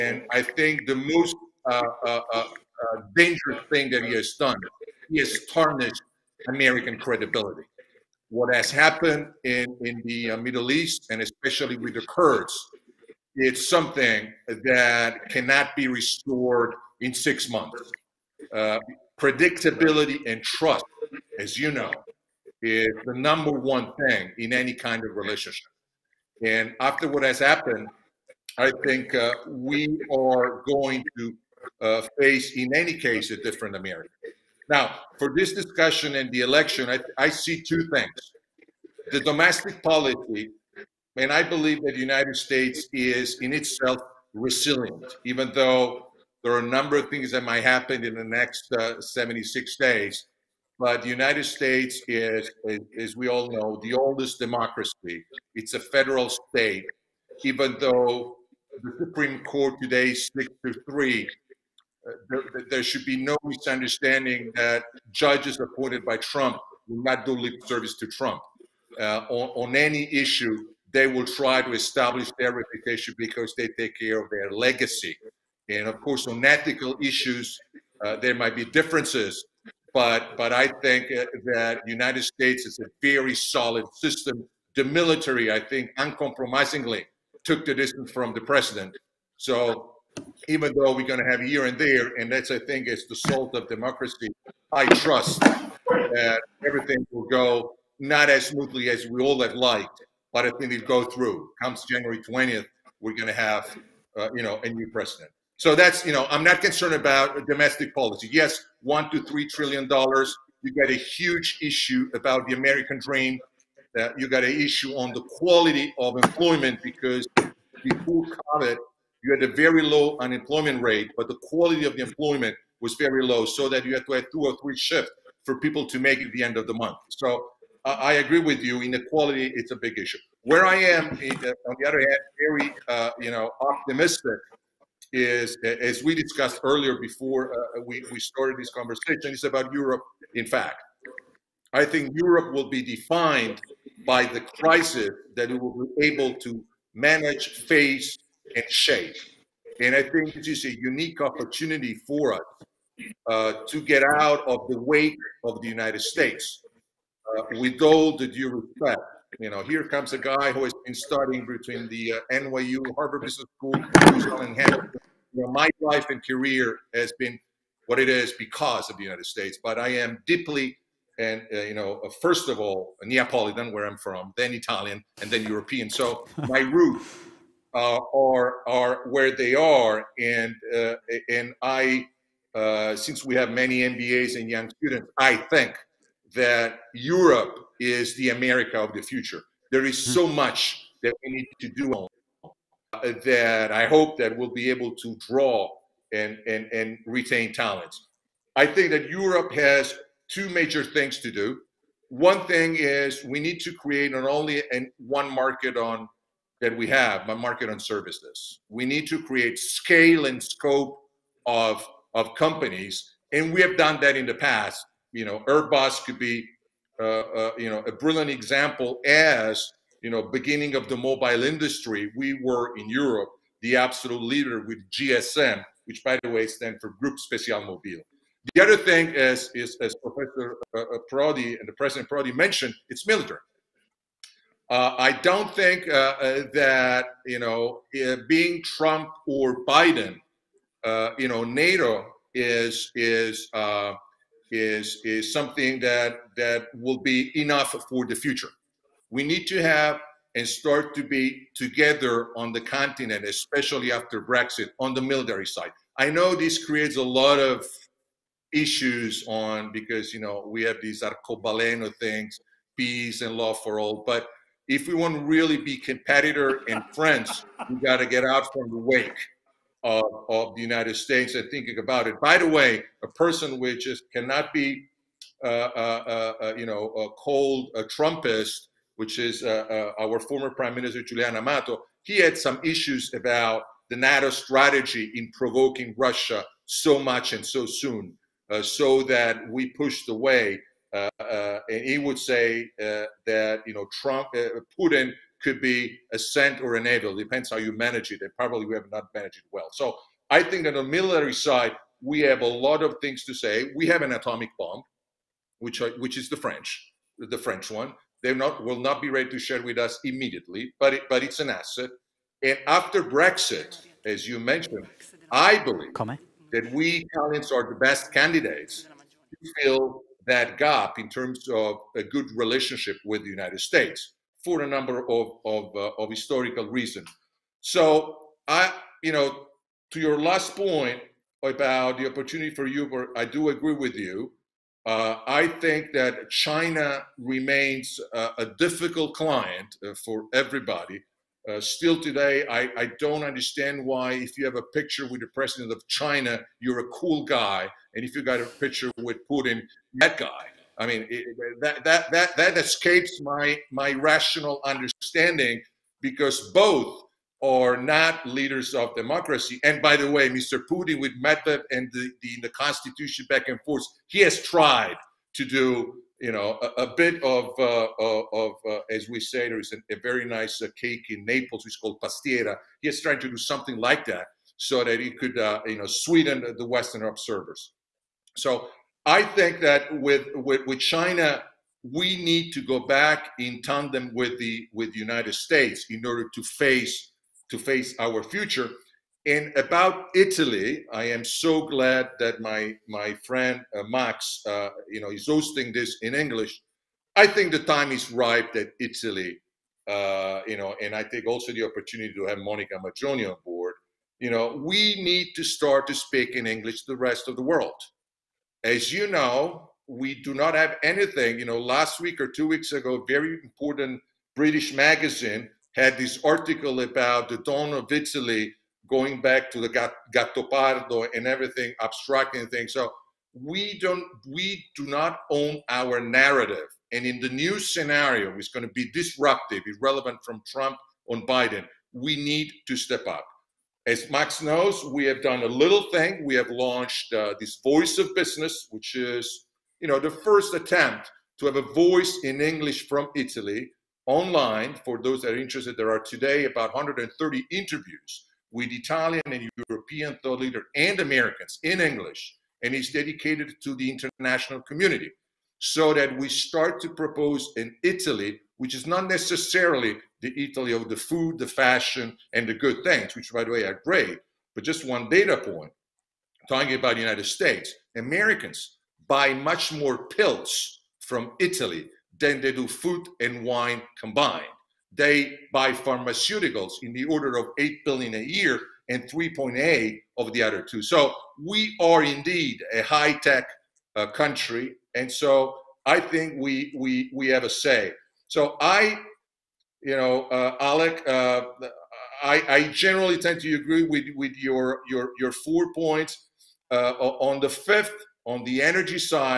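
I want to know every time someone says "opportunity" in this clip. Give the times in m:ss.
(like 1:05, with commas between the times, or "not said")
2:31, 5:32, 6:41.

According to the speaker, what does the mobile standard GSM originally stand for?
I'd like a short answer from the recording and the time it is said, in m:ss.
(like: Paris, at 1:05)
Group Special Mobile, at 3:47.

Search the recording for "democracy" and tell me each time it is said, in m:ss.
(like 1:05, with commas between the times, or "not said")
0:54, 1:33, 5:58.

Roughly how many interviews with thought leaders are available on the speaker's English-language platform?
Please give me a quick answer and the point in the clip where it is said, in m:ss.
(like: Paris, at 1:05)
130, at 7:26.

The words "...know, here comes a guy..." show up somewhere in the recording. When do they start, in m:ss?
2:39.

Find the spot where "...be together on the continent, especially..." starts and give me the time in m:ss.
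4:11.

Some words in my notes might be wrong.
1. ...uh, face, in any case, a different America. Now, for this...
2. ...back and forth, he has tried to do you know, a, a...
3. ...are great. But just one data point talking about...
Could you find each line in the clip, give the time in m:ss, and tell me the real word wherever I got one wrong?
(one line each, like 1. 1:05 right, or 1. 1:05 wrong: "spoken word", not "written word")
1. 0:31 right
2. 6:03 right
3. 7:43 right.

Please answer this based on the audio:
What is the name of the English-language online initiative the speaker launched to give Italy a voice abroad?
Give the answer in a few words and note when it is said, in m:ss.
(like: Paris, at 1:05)
Voice of Business, at 7:17.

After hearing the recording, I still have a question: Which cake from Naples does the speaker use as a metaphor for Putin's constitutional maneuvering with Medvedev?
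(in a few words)
Pastiera.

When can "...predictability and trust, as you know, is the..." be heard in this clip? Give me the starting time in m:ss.
0:19.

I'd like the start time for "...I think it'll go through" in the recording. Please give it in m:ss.
1:40.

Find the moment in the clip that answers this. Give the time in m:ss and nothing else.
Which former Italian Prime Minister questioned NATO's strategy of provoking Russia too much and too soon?
4:41.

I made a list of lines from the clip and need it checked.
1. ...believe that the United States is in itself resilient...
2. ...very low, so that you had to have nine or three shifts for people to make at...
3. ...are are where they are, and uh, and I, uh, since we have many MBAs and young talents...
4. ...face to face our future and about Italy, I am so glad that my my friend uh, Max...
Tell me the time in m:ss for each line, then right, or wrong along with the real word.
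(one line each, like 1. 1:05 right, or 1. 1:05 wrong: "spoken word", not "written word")
1. 0:41 right
2. 2:02 wrong: "two", not "nine"
3. 2:58 wrong: "students", not "talents"
4. 6:26 right.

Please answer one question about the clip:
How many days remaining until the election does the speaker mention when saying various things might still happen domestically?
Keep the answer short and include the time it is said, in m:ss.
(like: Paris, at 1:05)
76, at 0:48.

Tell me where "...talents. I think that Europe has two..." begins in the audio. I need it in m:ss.
3:17.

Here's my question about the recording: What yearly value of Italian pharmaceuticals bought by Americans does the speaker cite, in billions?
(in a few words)
8 billion.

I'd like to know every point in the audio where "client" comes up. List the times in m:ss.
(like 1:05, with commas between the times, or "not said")
5:39.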